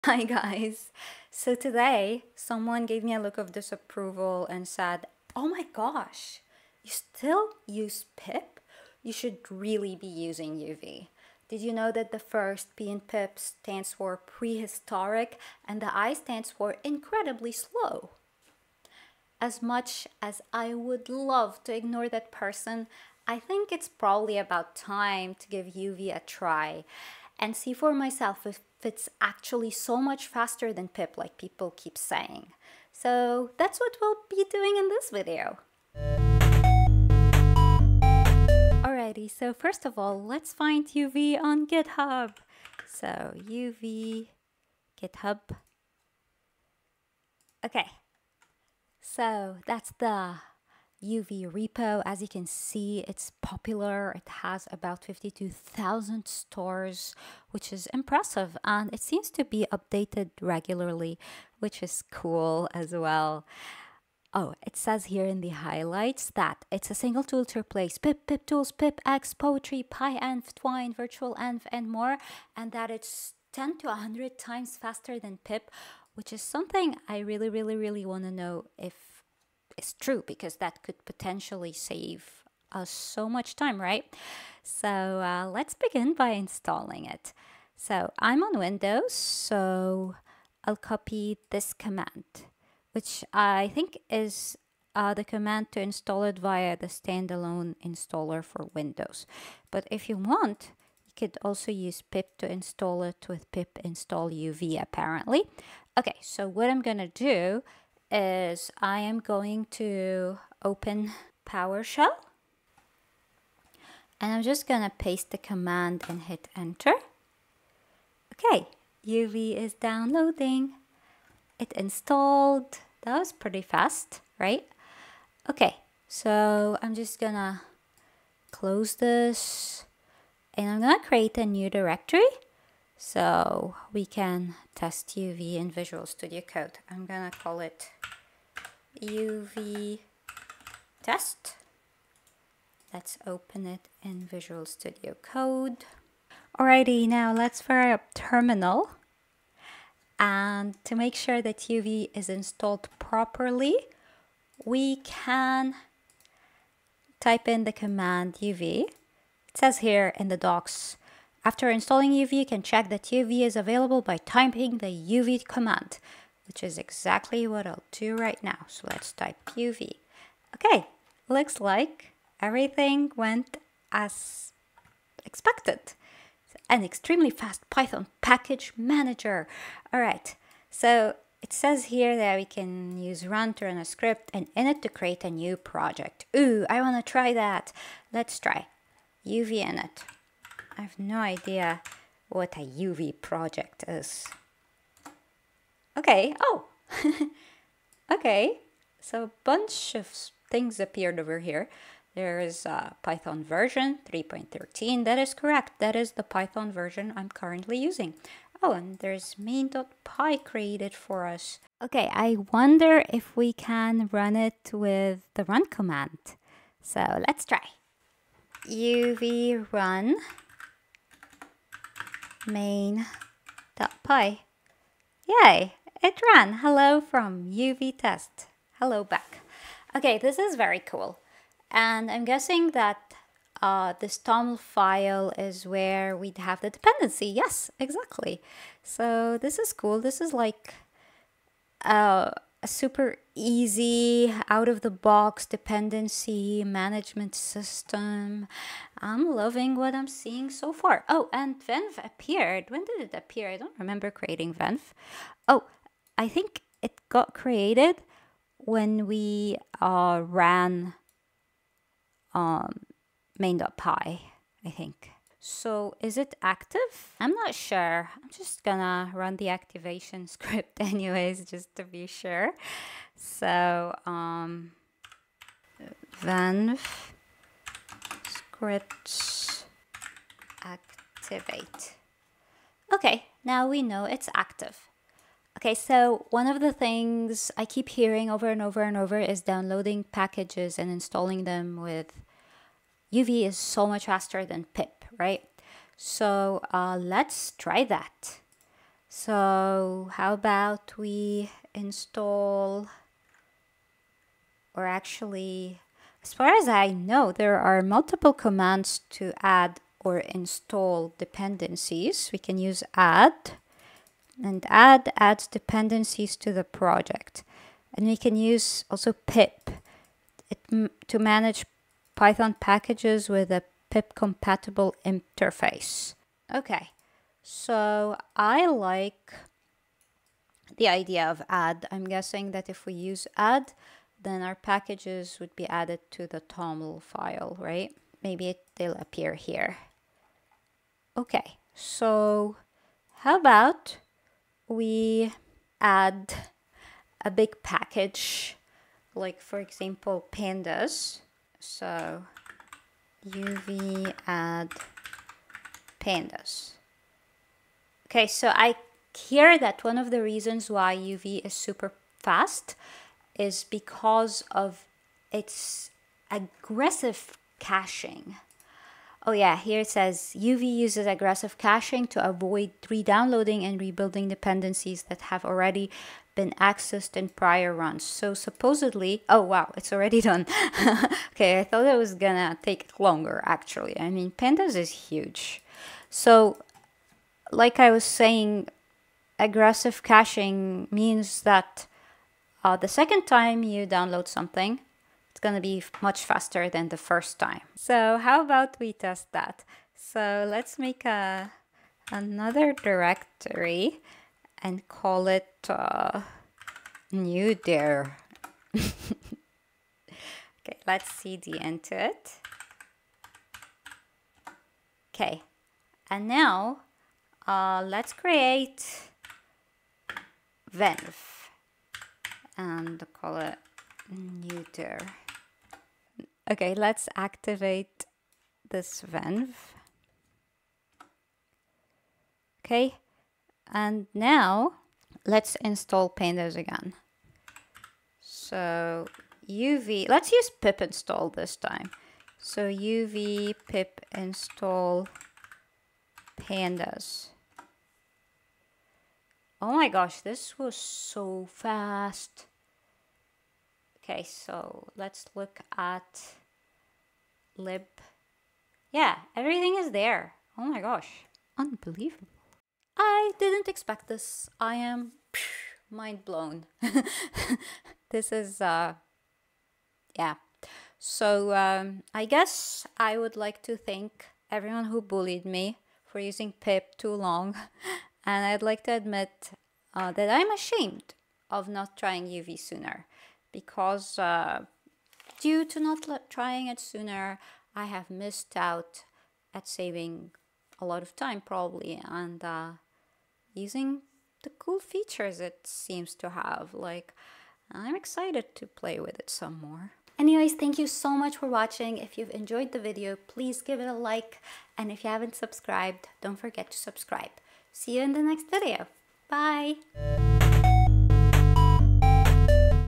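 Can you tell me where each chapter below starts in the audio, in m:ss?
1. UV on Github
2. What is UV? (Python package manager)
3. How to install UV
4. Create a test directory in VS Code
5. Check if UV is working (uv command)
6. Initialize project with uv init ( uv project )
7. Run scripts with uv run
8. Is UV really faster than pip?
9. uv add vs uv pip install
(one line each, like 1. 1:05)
1. 0:39
2. 1:03
3. 1:24
4. 2:09
5. 2:27
6. 3:04
7. 3:32
8. 4:46
9. 5:07.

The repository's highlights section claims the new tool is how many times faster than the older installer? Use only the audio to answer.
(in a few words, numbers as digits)
10 to 100.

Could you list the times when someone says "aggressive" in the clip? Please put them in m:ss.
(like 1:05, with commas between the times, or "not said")
6:06, 6:11, 6:29.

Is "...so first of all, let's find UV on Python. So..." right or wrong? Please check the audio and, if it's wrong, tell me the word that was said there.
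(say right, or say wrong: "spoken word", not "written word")
wrong: "GitHub", not "Python".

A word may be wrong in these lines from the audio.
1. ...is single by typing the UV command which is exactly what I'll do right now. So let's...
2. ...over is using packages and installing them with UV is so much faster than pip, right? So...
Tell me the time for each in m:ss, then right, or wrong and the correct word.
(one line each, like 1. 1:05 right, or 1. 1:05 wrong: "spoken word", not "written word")
1. 2:43 wrong: "available", not "single"
2. 4:48 wrong: "downloading", not "using".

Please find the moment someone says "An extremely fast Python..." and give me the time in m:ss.
2:56.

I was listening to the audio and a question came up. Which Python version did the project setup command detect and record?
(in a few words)
3.13.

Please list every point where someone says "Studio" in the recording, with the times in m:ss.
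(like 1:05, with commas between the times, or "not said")
2:16, 2:24.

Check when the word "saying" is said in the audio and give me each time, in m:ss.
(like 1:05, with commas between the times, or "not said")
0:31, 6:28.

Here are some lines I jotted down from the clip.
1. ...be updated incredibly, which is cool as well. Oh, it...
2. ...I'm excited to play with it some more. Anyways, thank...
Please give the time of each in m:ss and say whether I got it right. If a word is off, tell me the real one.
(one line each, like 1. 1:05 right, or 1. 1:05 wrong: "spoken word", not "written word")
1. 0:59 wrong: "regularly", not "incredibly"
2. 8:17 right.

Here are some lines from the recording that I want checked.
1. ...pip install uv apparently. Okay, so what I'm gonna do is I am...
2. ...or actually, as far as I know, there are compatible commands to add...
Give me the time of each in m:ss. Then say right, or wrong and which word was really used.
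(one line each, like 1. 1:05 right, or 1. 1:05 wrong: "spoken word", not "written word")
1. 1:43 right
2. 5:04 wrong: "multiple", not "compatible".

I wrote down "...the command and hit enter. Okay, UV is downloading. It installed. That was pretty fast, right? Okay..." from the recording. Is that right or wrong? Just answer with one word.
right.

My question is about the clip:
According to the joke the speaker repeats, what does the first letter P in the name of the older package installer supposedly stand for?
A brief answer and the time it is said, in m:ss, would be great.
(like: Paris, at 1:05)
prehistoric, at 0:14.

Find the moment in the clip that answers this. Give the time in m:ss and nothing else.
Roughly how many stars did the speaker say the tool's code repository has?
0:55.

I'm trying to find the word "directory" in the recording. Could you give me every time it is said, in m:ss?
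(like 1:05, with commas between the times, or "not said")
2:11, 6:42.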